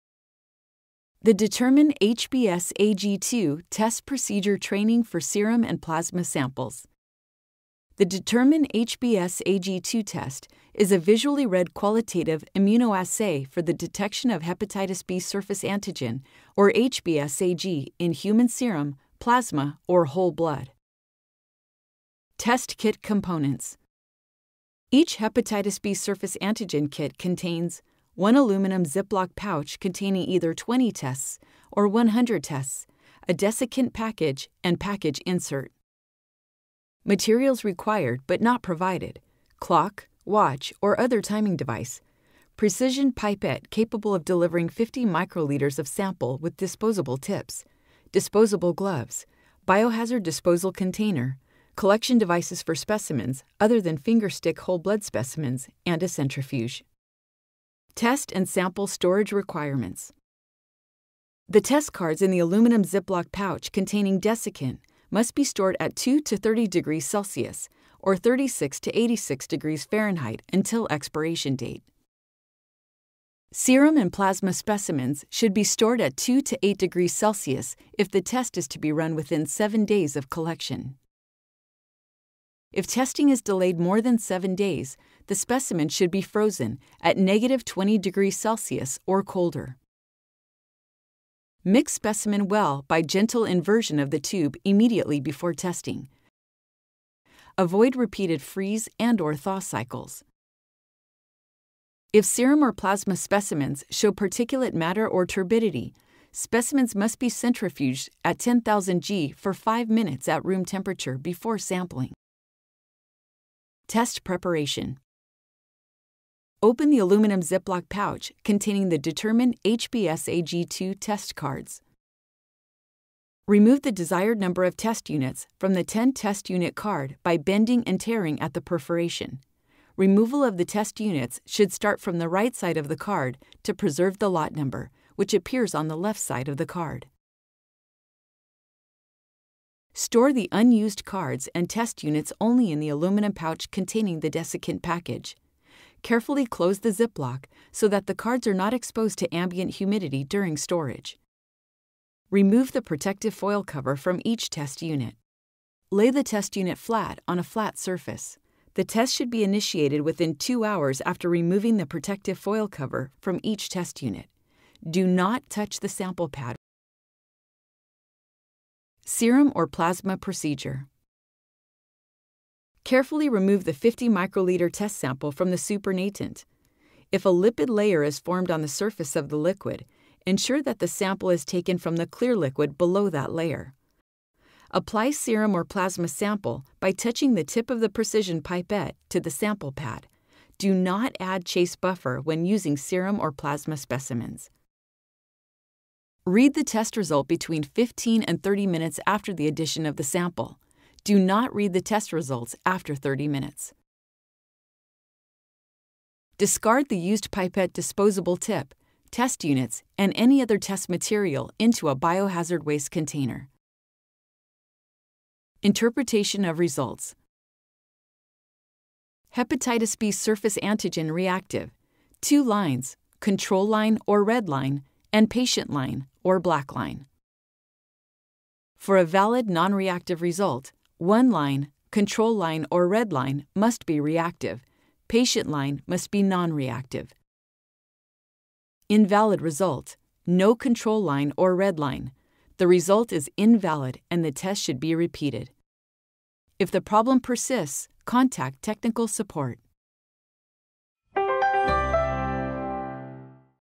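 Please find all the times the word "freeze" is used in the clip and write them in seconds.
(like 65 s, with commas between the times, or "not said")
98 s.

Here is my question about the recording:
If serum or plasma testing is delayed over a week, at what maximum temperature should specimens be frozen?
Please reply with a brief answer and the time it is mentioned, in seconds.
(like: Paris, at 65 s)
-20 degrees Celsius, at 87 s.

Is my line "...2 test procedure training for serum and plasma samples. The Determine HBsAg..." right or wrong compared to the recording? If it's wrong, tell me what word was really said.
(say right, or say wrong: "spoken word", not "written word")
right.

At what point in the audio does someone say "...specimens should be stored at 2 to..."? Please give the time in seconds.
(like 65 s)
74 s.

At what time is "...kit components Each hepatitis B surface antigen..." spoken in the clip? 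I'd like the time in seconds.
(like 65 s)
22 s.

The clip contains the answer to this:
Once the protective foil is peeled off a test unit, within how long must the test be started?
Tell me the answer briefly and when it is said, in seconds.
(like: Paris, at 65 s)
2 hours, at 160 s.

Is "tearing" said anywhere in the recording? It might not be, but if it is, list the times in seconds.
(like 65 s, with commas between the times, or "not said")
127 s.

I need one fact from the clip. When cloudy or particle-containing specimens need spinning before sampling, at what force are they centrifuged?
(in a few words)
10,000 G.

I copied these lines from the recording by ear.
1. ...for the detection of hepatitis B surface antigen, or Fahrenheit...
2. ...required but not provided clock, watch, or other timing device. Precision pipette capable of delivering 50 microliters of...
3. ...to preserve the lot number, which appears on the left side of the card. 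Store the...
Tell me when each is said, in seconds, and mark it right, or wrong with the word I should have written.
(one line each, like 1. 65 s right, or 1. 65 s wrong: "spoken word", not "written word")
1. 13 s wrong: "HBsAg", not "Fahrenheit"
2. 37 s right
3. 133 s right.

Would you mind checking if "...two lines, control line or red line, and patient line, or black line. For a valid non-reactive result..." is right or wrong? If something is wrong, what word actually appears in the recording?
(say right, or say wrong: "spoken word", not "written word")
right.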